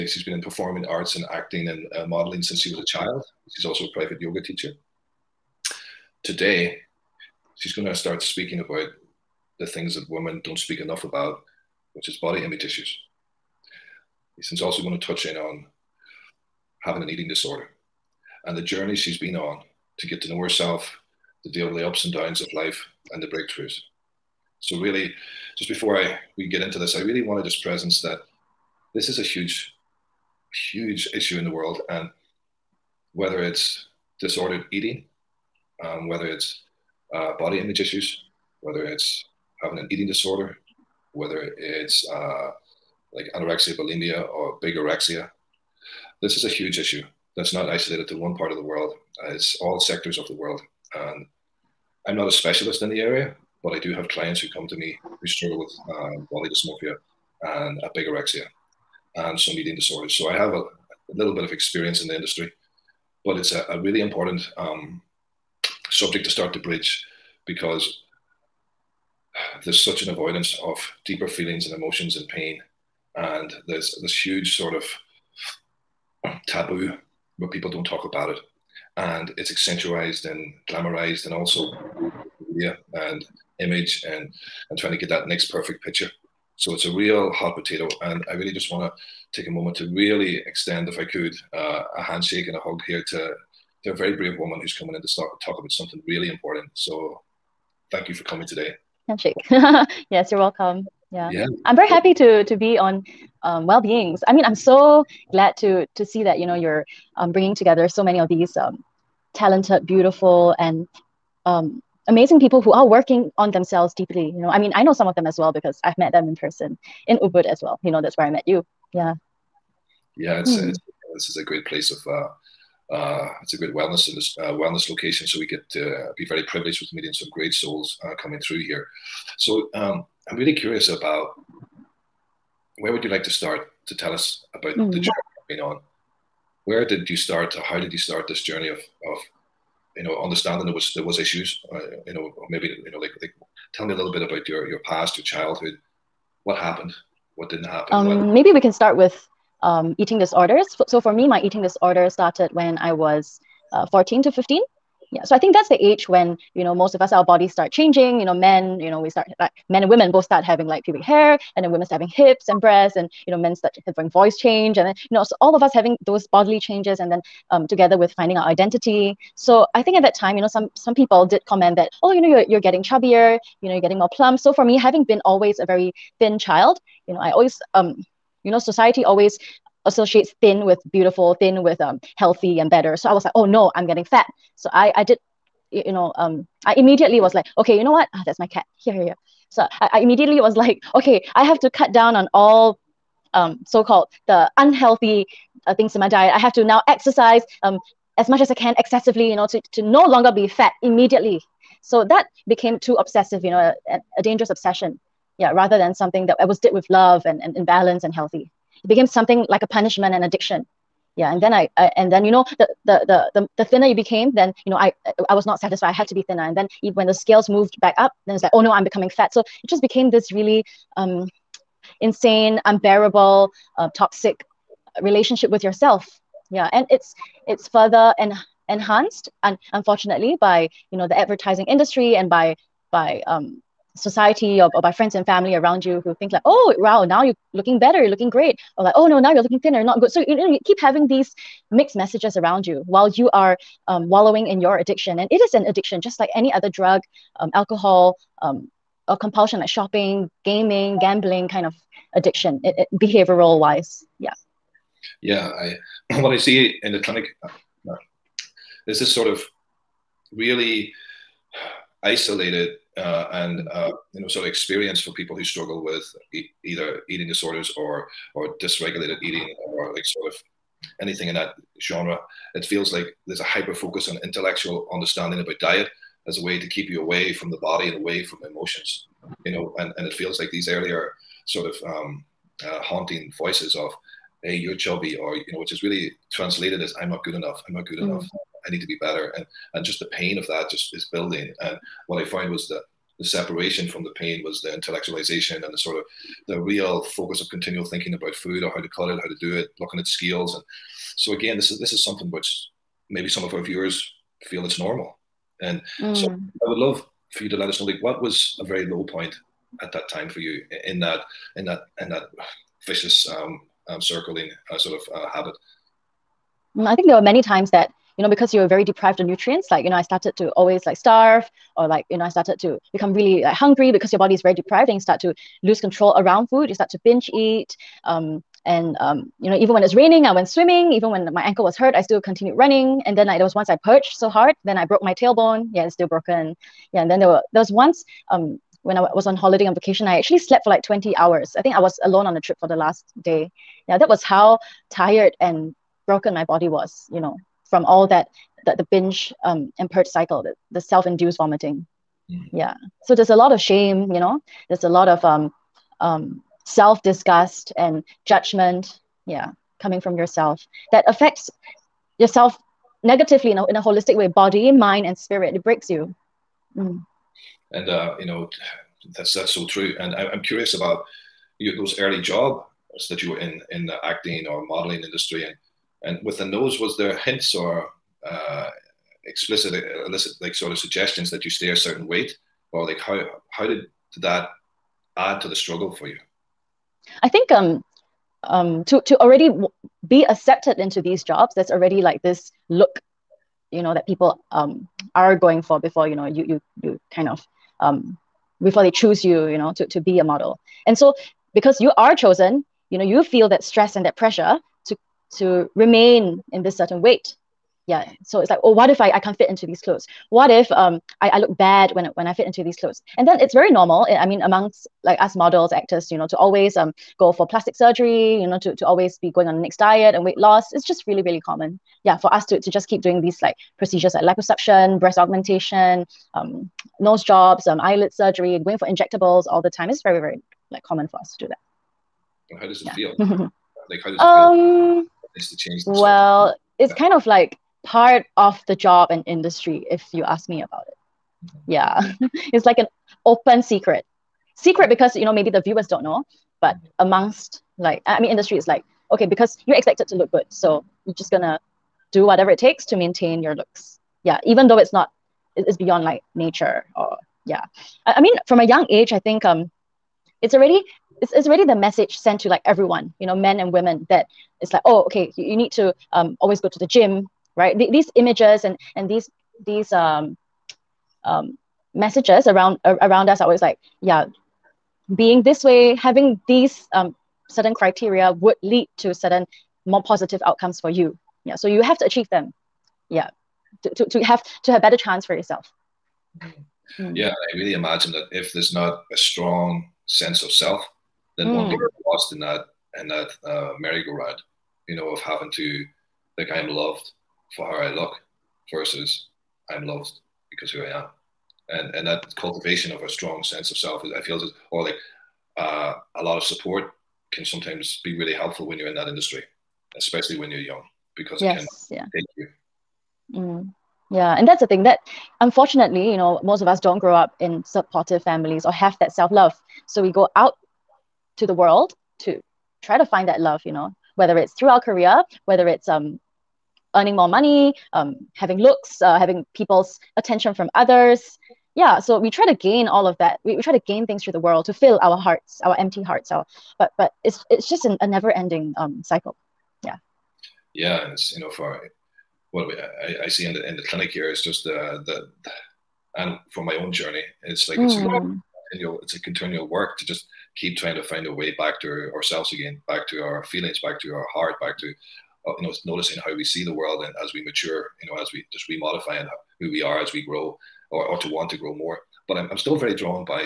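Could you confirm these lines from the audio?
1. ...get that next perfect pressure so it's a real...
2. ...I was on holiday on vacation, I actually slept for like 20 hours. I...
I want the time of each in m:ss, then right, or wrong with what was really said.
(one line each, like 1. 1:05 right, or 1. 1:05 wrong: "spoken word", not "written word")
1. 1:24 wrong: "picture", not "pressure"
2. 5:38 right.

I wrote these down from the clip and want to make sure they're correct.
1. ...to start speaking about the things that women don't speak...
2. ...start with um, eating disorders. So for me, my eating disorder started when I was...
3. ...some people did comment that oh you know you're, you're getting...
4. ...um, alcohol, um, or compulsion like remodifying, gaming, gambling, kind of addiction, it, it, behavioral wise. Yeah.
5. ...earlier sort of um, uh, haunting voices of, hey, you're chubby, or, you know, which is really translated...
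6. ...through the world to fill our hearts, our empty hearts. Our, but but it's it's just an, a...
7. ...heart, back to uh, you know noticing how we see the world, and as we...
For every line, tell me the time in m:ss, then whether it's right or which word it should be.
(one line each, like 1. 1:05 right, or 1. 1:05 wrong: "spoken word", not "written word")
1. 0:07 right
2. 2:28 right
3. 2:50 right
4. 4:07 wrong: "shopping", not "remodifying"
5. 4:40 right
6. 8:54 right
7. 9:14 right.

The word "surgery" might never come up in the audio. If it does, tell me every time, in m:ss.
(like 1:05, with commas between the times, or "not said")
6:57, 7:08.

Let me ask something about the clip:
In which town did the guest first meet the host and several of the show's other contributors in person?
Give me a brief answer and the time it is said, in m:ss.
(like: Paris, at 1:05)
Ubud, at 1:57.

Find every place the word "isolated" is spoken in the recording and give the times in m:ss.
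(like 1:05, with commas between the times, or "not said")
0:47, 4:22.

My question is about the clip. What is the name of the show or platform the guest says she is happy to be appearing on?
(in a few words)
Well Beings.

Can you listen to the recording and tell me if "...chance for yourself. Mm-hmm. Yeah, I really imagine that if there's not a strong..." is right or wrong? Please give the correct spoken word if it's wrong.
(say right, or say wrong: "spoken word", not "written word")
right.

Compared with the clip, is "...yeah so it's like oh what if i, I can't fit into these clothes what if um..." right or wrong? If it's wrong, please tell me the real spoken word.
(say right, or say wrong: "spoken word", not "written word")
right.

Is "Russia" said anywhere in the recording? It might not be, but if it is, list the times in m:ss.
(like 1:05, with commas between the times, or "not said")
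not said.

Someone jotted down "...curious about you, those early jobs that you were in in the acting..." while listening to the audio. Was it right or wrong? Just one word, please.
right.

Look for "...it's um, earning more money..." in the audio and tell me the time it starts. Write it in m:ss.
8:45.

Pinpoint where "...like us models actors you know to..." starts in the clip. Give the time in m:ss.
6:55.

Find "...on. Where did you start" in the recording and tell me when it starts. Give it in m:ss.
2:15.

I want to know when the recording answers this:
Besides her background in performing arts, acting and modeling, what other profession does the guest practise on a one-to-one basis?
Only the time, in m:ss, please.
0:03.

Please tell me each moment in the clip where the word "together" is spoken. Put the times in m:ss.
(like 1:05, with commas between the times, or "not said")
1:47, 2:47.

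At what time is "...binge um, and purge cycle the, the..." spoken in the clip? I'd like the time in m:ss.
5:48.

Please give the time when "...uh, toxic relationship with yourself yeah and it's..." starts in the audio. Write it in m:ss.
3:43.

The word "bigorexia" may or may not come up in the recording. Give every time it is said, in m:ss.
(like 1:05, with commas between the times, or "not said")
0:44, 0:57.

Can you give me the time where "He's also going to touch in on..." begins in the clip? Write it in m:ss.
0:14.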